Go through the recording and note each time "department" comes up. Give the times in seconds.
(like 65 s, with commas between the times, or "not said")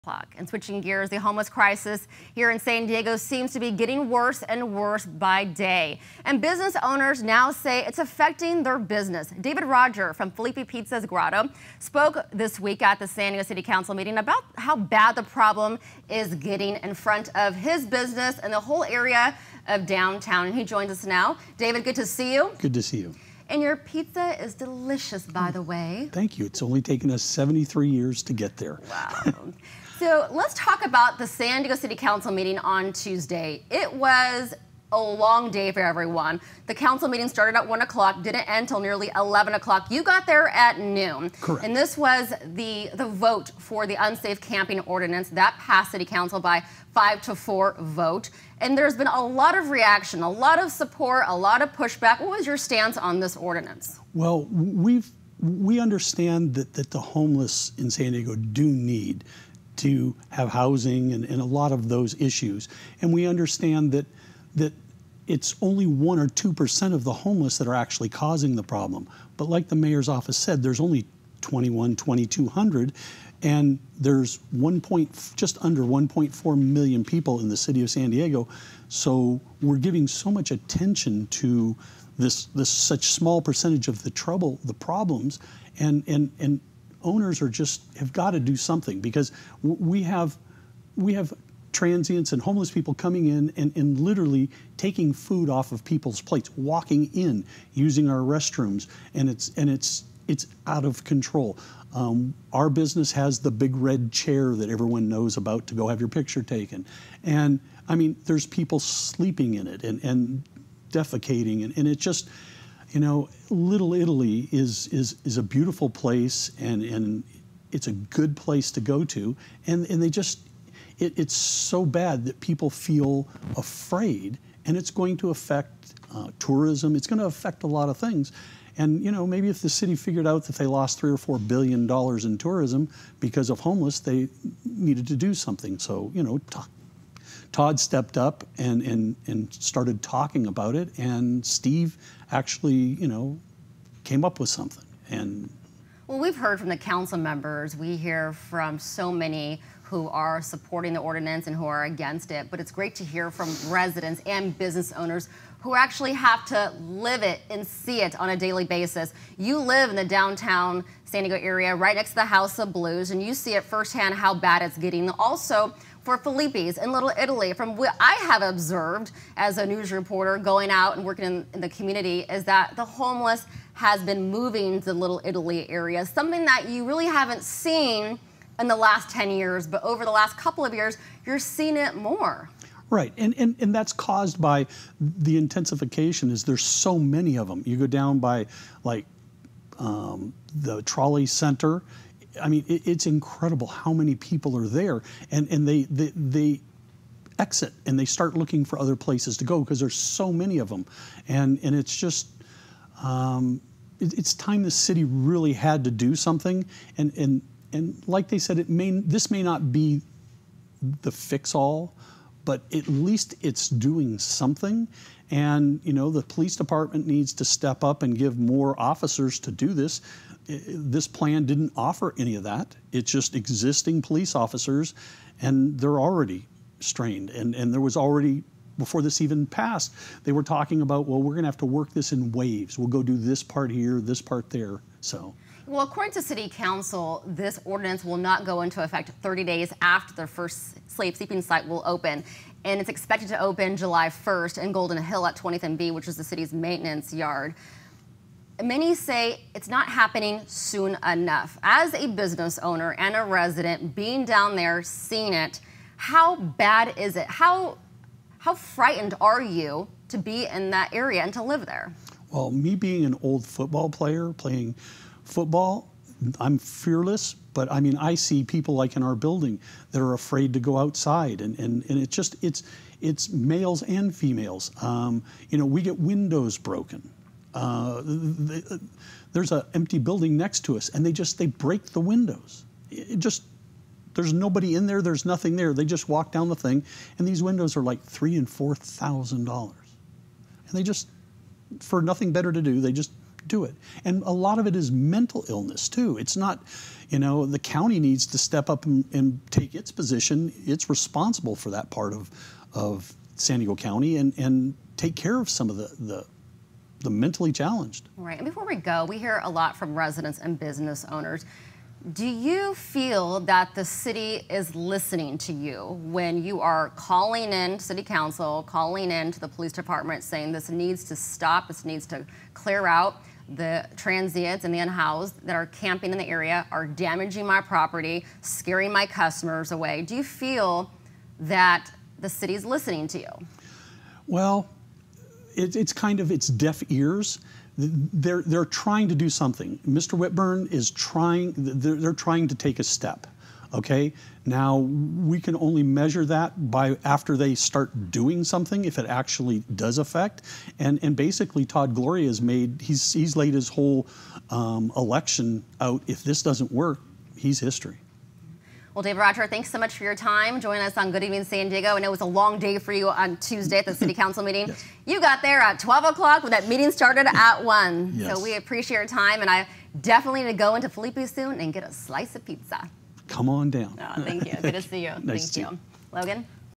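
216 s, 319 s.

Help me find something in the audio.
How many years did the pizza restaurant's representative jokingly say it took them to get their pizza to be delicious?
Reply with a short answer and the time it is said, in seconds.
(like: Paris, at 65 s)
73, at 27 s.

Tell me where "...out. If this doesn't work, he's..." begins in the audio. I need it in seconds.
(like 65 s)
355 s.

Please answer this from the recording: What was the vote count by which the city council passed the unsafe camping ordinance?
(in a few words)
5 to 4.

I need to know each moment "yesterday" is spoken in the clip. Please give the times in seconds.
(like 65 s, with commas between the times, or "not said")
not said.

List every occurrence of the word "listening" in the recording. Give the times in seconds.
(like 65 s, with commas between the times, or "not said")
314 s, 332 s.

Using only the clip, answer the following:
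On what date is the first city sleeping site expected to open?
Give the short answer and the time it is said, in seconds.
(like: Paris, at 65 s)
July 1st, at 243 s.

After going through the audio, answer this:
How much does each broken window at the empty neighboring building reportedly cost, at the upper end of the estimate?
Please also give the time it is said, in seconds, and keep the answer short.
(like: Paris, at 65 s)
4000 dollars, at 288 s.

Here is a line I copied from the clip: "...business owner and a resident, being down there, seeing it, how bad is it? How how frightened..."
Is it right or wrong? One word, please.
right.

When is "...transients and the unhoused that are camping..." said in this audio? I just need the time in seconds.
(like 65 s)
323 s.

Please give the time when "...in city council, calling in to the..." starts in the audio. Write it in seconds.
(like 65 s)
317 s.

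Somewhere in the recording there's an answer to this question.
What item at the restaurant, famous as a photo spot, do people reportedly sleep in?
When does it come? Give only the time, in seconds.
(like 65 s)
103 s.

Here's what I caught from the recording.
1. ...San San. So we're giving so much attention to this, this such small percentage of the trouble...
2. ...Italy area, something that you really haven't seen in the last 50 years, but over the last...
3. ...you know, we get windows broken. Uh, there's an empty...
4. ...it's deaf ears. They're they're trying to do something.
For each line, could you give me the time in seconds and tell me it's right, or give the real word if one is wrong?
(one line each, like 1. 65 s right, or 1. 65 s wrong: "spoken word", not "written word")
1. 77 s wrong: "Diego", not "San"
2. 175 s wrong: "10", not "50"
3. 275 s right
4. 336 s right.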